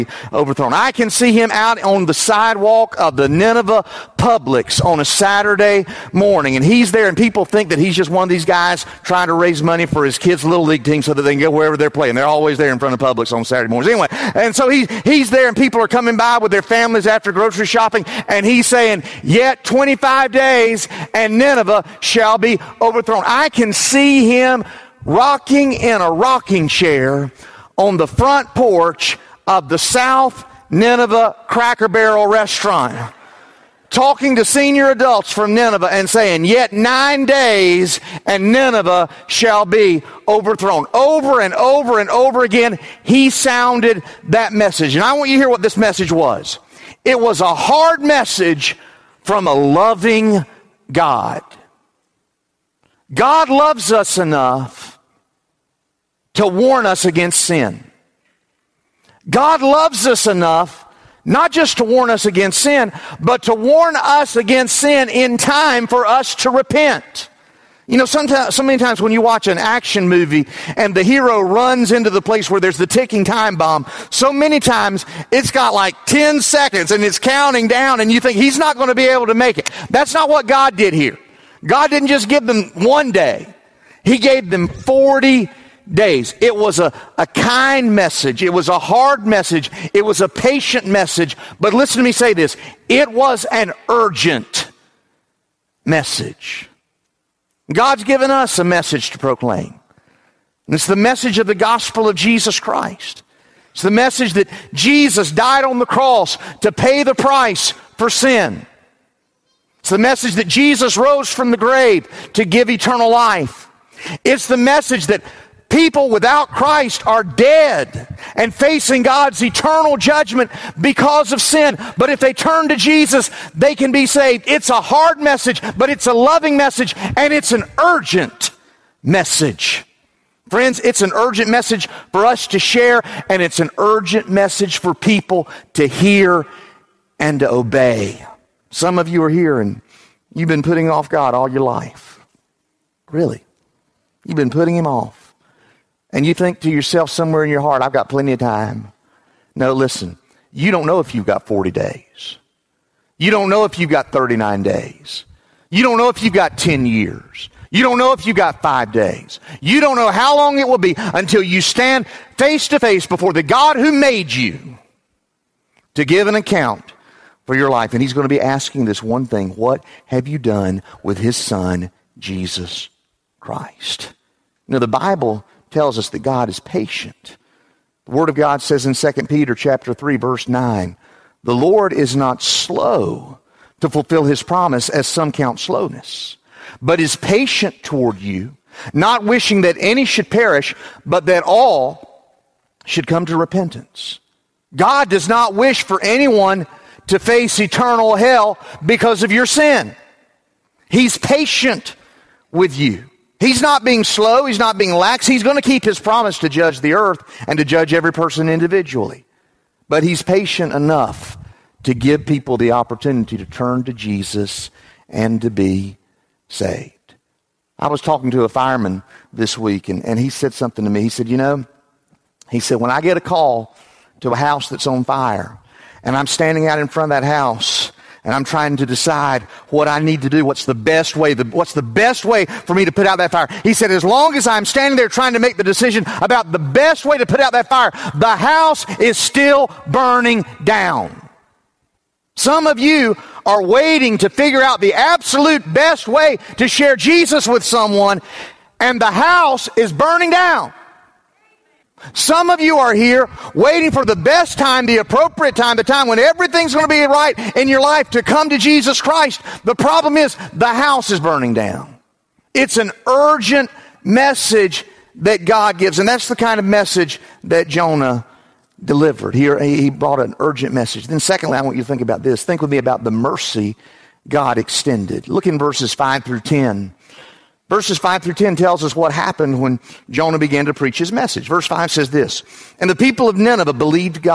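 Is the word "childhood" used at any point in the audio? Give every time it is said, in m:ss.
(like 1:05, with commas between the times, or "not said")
not said.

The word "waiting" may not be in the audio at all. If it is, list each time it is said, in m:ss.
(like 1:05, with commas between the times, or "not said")
4:03, 4:13.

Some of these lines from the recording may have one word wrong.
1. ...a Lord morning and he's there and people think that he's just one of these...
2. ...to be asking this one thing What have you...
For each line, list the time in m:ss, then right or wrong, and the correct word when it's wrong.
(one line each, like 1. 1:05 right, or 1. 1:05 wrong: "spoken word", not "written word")
1. 0:05 wrong: "Saturday", not "Lord"
2. 2:48 right.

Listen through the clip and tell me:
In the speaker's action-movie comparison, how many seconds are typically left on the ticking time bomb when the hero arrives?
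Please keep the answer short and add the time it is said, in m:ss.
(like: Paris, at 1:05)
10, at 1:16.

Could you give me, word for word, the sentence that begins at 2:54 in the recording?
You know, the Bible tells us that God is patient.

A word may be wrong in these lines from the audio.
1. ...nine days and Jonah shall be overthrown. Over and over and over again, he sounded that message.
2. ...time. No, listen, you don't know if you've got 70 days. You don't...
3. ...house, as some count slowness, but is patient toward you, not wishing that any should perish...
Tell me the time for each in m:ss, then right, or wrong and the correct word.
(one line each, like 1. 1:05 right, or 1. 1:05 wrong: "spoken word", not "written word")
1. 0:36 wrong: "Nineveh", not "Jonah"
2. 2:28 wrong: "40", not "70"
3. 3:04 wrong: "promise", not "house".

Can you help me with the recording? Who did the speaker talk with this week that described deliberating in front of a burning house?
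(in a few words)
A fireman.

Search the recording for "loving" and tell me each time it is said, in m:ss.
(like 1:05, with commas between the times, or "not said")
0:49, 2:06.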